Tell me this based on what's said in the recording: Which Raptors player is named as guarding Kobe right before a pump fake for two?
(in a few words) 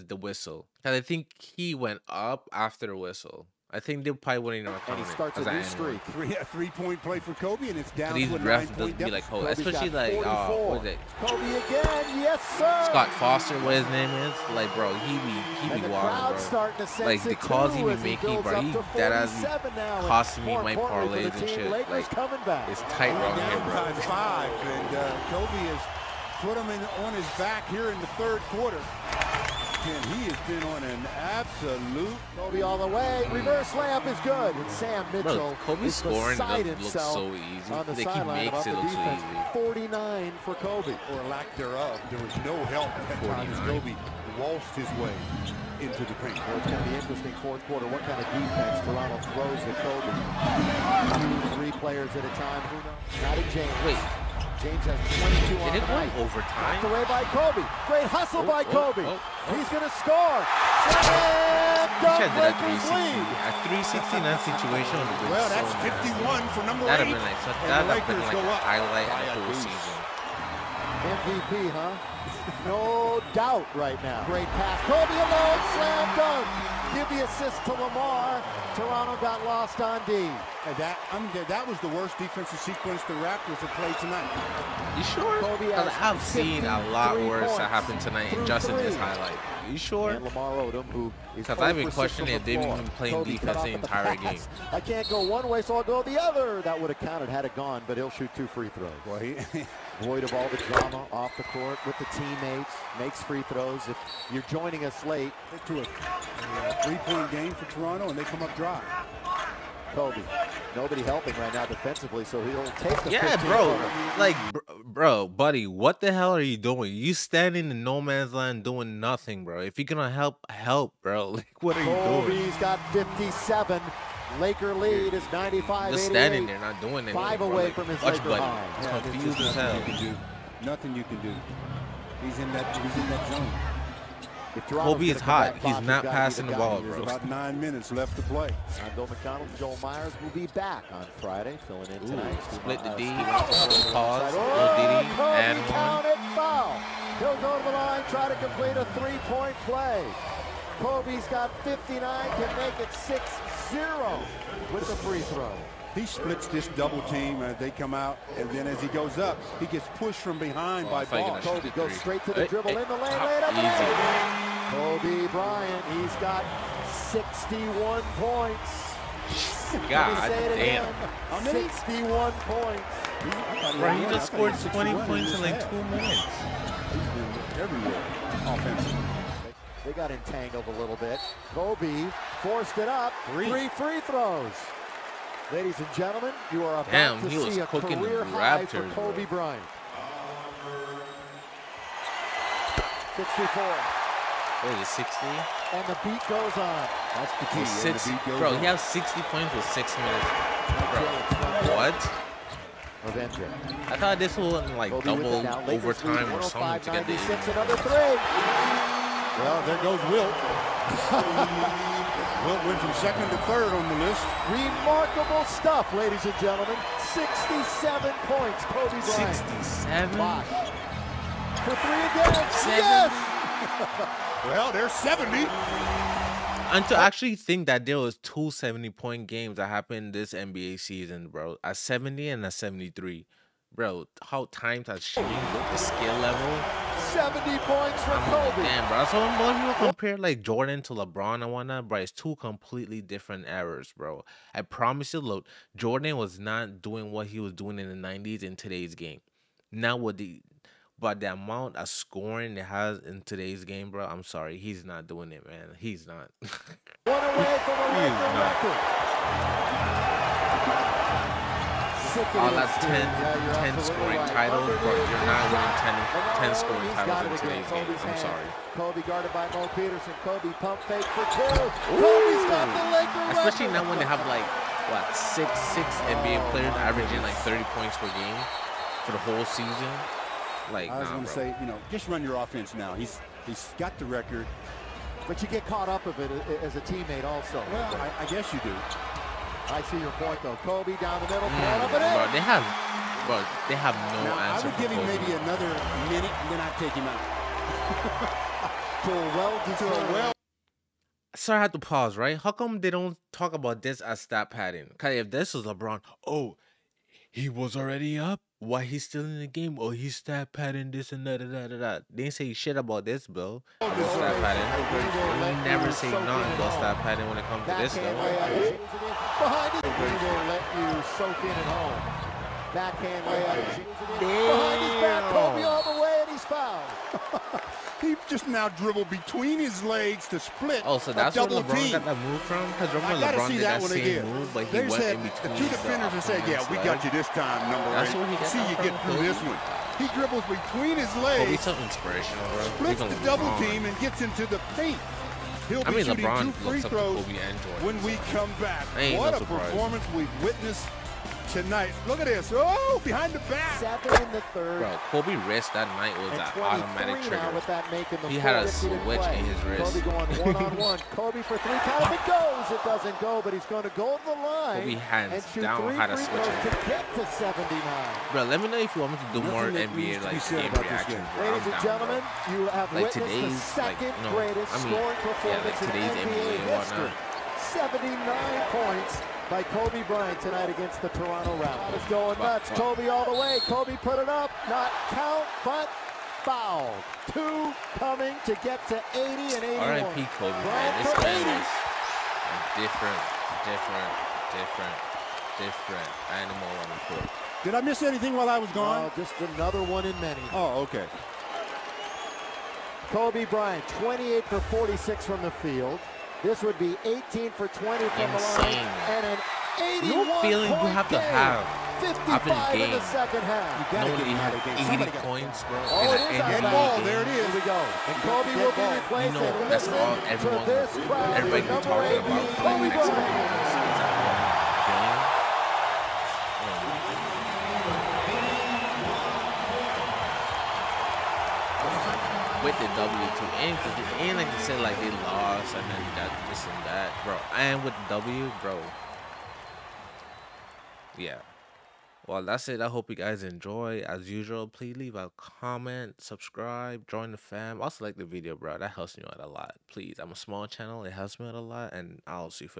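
Mo Peterson.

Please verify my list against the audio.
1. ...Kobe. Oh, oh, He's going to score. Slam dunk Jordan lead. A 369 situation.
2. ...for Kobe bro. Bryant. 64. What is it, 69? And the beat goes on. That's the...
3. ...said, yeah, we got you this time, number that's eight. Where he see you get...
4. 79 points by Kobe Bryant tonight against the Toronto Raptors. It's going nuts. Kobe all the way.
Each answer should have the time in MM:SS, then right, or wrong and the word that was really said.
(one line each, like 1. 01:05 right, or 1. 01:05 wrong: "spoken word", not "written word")
1. 00:58 wrong: "Lakers", not "Jordan"
2. 03:08 wrong: "60", not "69"
3. 05:36 right
4. 06:17 right.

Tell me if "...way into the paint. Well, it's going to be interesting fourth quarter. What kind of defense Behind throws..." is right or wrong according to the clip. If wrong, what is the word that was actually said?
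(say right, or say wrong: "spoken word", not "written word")
wrong: "Toronto", not "Behind".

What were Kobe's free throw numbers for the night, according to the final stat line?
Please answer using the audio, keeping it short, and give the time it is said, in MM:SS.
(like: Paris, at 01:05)
18 for 20, at 06:47.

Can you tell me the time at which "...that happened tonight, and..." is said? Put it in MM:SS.
01:27.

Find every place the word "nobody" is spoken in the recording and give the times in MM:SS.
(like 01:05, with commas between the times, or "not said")
01:50, 06:54.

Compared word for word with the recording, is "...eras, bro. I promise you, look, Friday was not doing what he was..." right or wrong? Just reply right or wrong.
wrong.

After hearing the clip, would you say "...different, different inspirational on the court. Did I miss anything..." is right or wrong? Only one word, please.
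wrong.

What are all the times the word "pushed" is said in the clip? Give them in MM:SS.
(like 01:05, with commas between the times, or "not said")
02:39.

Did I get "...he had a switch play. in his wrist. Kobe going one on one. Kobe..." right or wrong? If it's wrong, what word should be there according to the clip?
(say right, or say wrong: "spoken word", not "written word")
right.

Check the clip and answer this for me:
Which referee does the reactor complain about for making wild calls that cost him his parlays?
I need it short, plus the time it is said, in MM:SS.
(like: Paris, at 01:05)
Scott Foster, at 00:12.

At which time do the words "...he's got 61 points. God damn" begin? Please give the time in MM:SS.
02:45.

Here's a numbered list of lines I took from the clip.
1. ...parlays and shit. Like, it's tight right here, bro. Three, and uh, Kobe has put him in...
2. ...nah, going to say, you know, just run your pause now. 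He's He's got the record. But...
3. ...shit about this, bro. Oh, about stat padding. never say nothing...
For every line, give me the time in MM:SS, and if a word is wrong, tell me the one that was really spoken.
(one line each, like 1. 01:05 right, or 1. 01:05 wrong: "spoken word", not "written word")
1. 00:20 wrong: "Five", not "Three"
2. 04:41 wrong: "offense", not "pause"
3. 05:12 right.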